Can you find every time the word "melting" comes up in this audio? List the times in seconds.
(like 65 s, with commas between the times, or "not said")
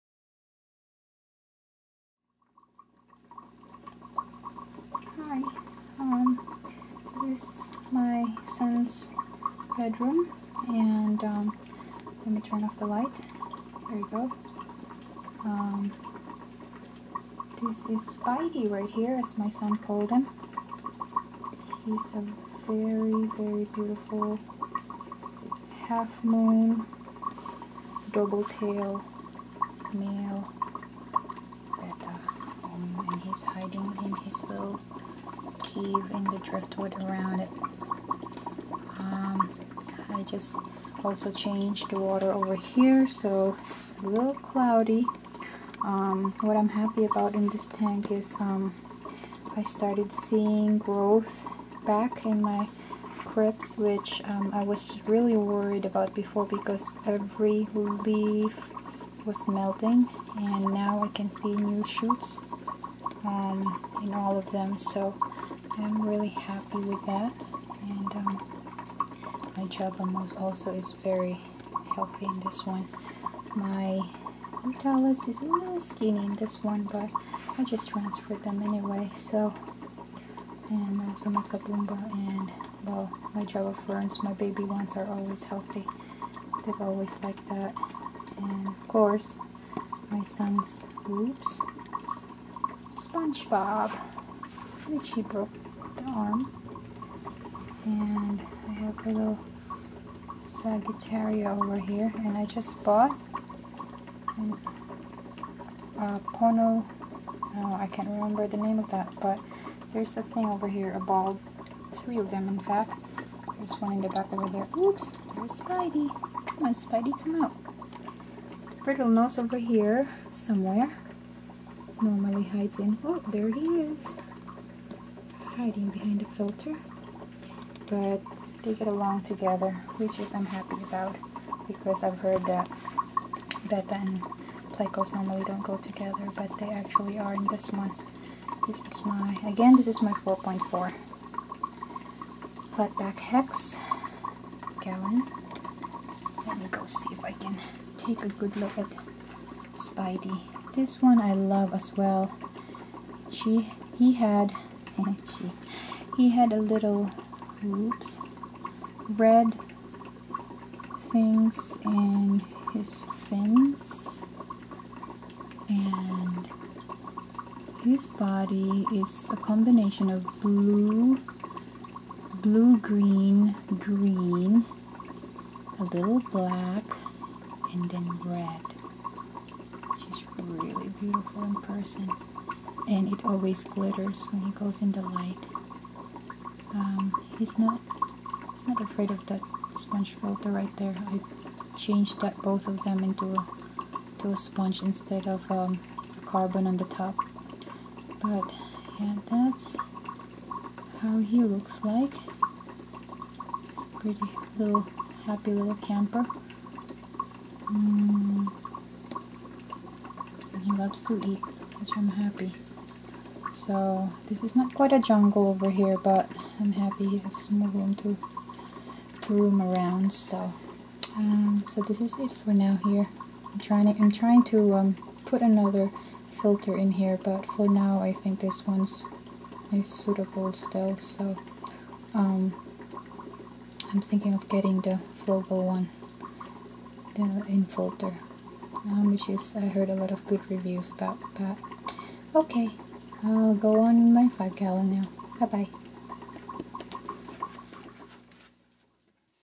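59 s.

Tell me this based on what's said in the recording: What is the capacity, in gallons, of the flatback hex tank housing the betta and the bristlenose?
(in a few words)
4.4.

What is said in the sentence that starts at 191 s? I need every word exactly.
I changed that both of them into a, to a sponge instead of um, carbon on the top.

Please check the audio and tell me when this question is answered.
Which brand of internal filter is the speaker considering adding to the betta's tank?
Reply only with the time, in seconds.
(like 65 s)
235 s.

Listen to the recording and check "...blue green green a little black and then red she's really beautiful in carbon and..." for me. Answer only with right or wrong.
wrong.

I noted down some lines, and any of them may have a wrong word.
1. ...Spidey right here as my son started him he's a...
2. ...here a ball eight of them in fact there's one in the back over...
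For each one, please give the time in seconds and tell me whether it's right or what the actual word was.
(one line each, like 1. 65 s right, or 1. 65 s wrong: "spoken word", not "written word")
1. 18 s wrong: "called", not "started"
2. 110 s wrong: "three", not "eight".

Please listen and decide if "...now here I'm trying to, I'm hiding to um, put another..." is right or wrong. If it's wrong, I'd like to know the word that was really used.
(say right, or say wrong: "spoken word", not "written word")
wrong: "trying", not "hiding".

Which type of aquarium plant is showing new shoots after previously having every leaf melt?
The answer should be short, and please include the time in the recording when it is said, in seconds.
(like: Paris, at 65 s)
crypts, at 53 s.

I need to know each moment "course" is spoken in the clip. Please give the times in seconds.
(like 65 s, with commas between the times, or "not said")
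88 s.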